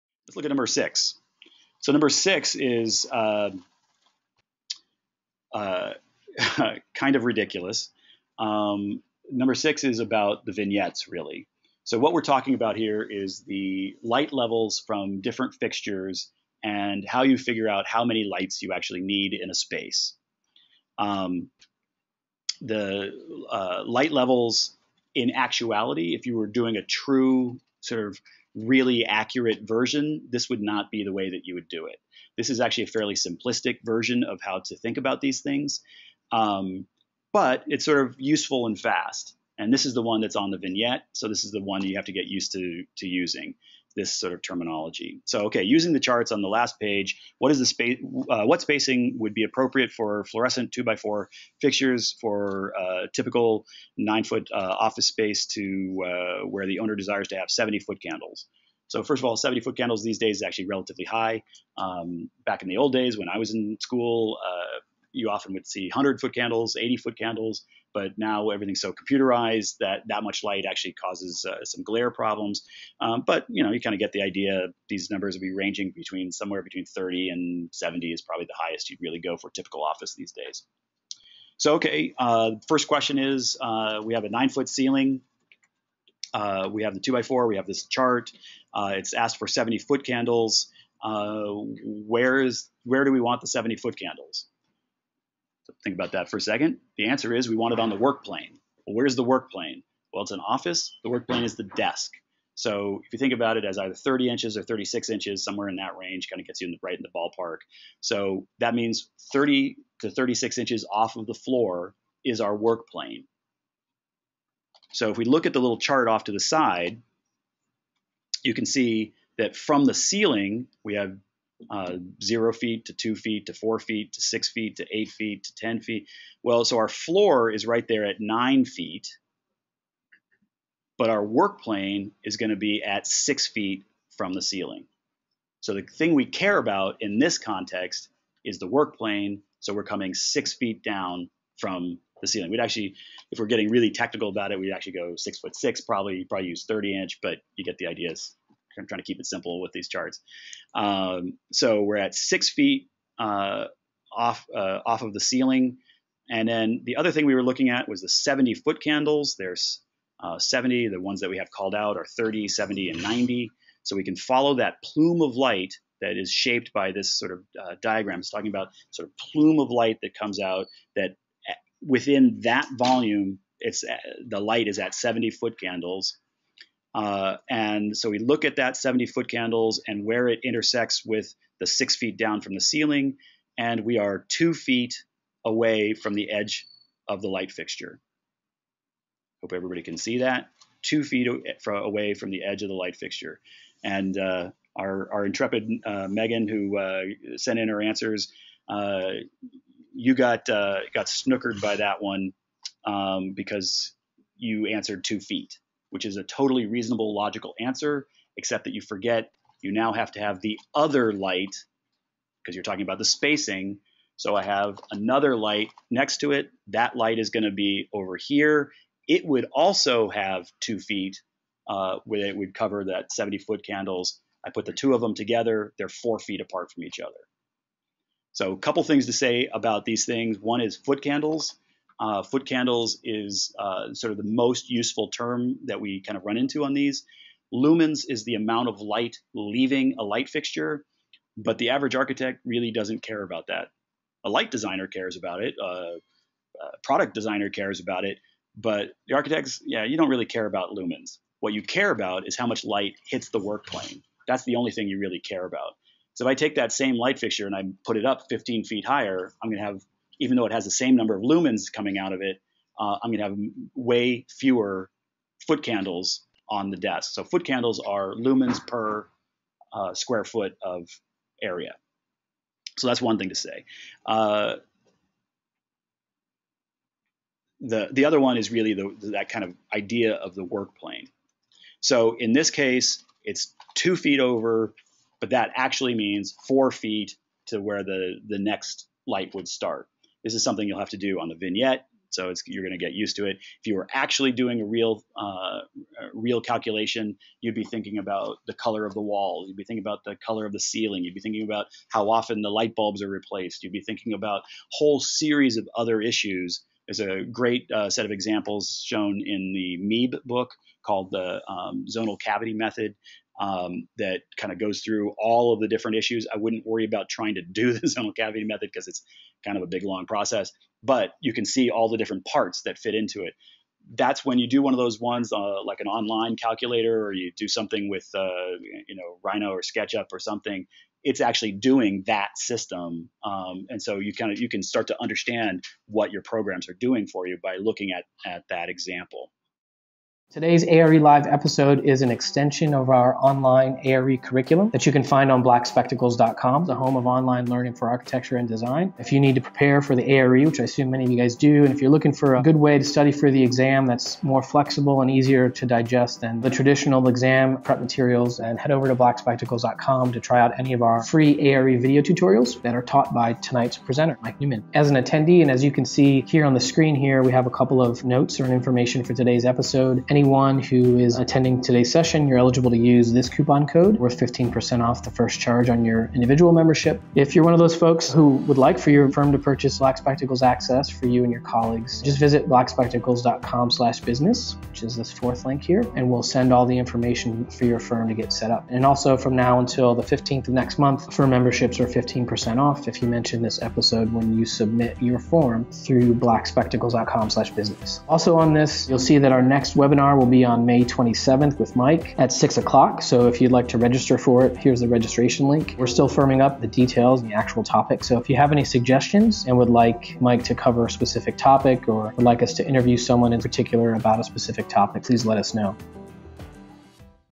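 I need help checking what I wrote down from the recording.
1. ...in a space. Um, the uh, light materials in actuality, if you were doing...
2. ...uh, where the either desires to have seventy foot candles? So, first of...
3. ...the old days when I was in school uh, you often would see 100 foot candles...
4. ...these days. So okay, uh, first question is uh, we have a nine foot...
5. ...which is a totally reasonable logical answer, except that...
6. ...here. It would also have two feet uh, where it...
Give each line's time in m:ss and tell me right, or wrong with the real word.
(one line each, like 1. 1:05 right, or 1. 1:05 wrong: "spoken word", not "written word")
1. 0:19 wrong: "levels", not "materials"
2. 0:56 wrong: "owner", not "either"
3. 1:02 right
4. 1:20 right
5. 3:25 right
6. 3:38 right.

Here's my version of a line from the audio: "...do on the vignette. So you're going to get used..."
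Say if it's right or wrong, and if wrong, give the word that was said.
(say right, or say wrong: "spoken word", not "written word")
right.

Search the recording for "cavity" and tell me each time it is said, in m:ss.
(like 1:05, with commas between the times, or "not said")
5:12, 5:18.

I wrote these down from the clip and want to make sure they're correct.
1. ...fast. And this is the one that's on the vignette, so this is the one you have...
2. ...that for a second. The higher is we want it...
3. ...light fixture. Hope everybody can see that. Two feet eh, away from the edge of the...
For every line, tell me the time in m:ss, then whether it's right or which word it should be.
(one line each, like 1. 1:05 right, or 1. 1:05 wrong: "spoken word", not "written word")
1. 0:38 right
2. 1:36 wrong: "answer", not "higher"
3. 3:07 right.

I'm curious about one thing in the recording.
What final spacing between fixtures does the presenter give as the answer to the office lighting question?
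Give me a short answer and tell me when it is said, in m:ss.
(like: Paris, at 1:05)
4 feet, at 3:45.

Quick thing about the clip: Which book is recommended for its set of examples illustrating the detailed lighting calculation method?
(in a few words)
MEEB.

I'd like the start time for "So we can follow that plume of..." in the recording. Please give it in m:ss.
2:43.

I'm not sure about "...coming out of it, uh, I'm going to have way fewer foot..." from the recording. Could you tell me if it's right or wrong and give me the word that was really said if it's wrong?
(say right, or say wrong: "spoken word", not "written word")
right.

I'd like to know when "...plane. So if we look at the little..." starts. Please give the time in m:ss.
1:52.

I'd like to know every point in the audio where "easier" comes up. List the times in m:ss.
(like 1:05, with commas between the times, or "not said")
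5:55.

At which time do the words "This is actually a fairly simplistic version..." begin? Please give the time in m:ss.
0:32.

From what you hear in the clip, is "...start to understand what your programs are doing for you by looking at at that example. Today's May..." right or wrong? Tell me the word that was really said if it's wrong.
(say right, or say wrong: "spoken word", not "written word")
wrong: "ARE", not "May".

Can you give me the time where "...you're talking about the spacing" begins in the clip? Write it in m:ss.
3:32.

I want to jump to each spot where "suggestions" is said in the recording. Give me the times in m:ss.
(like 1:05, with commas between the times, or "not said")
6:48.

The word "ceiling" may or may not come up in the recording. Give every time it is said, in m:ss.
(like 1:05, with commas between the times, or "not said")
1:24, 1:59, 2:14, 2:22, 2:35, 3:02, 5:00.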